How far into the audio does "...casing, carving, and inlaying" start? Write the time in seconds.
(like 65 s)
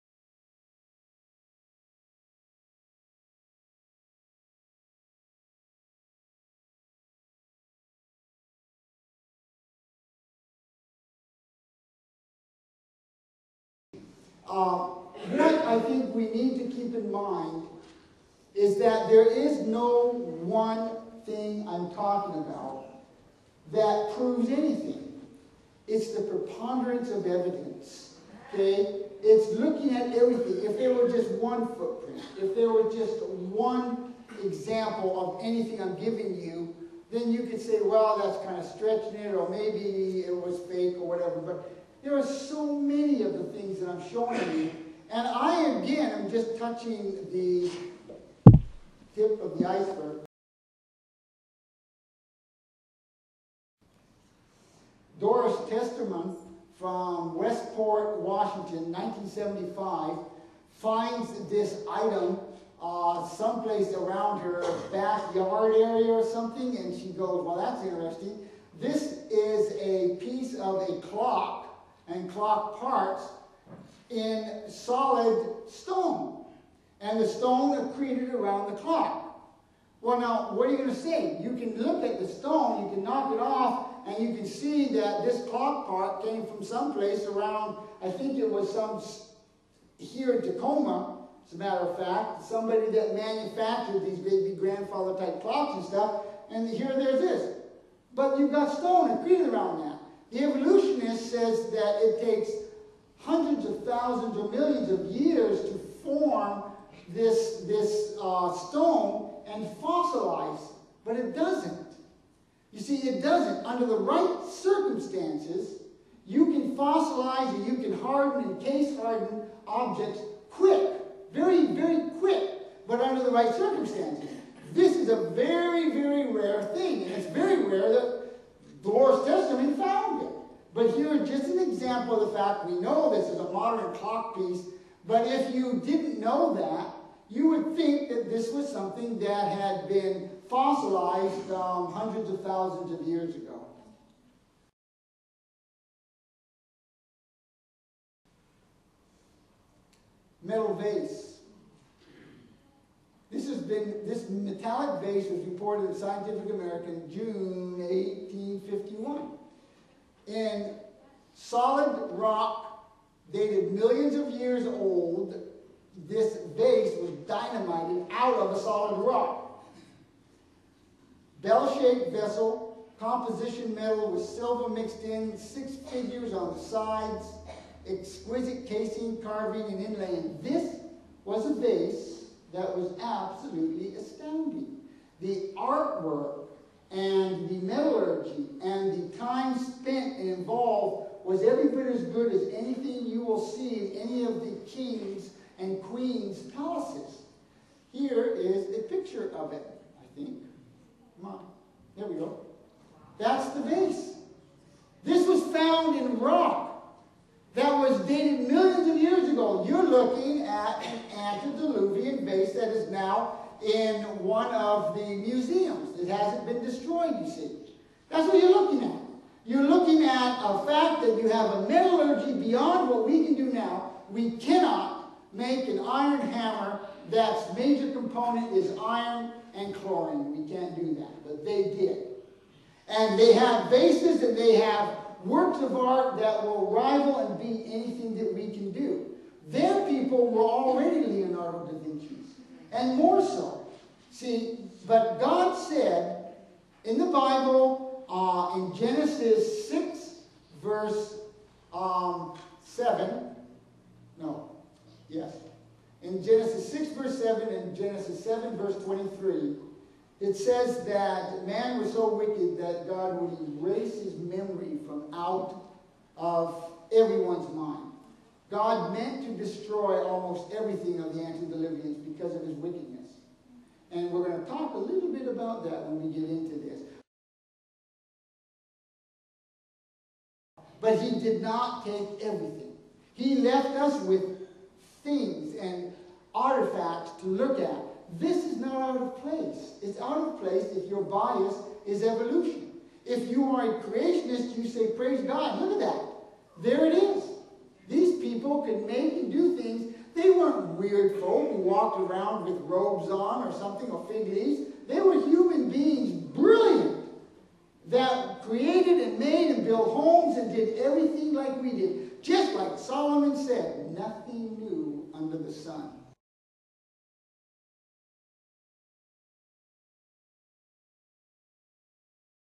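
178 s.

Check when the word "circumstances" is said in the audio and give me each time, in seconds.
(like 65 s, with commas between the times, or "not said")
114 s, 123 s.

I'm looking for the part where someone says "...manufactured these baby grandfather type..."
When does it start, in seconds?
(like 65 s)
93 s.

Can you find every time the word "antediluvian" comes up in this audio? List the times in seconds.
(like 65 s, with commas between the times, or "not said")
211 s, 271 s.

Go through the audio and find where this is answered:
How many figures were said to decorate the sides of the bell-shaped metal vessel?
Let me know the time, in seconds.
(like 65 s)
175 s.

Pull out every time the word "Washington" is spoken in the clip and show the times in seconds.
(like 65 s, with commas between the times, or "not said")
58 s.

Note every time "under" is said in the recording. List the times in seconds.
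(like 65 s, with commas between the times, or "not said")
113 s, 122 s, 315 s.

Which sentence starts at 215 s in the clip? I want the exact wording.
It hasn't been destroyed, you see.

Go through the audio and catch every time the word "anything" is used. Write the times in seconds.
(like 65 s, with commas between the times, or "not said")
24 s, 35 s, 192 s, 237 s.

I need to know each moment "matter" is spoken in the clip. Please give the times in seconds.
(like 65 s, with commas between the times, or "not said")
91 s.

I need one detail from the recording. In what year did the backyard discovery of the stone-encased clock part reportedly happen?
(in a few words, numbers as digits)
1975.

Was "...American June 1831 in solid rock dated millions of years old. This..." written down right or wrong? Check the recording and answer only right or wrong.
wrong.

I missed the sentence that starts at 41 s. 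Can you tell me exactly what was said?
But there are so many of the things that I'm showing you.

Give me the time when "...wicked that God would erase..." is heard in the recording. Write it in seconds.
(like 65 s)
262 s.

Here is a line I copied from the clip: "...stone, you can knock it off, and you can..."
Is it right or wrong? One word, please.
right.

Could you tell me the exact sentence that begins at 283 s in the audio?
He left us with things and artifacts to look at.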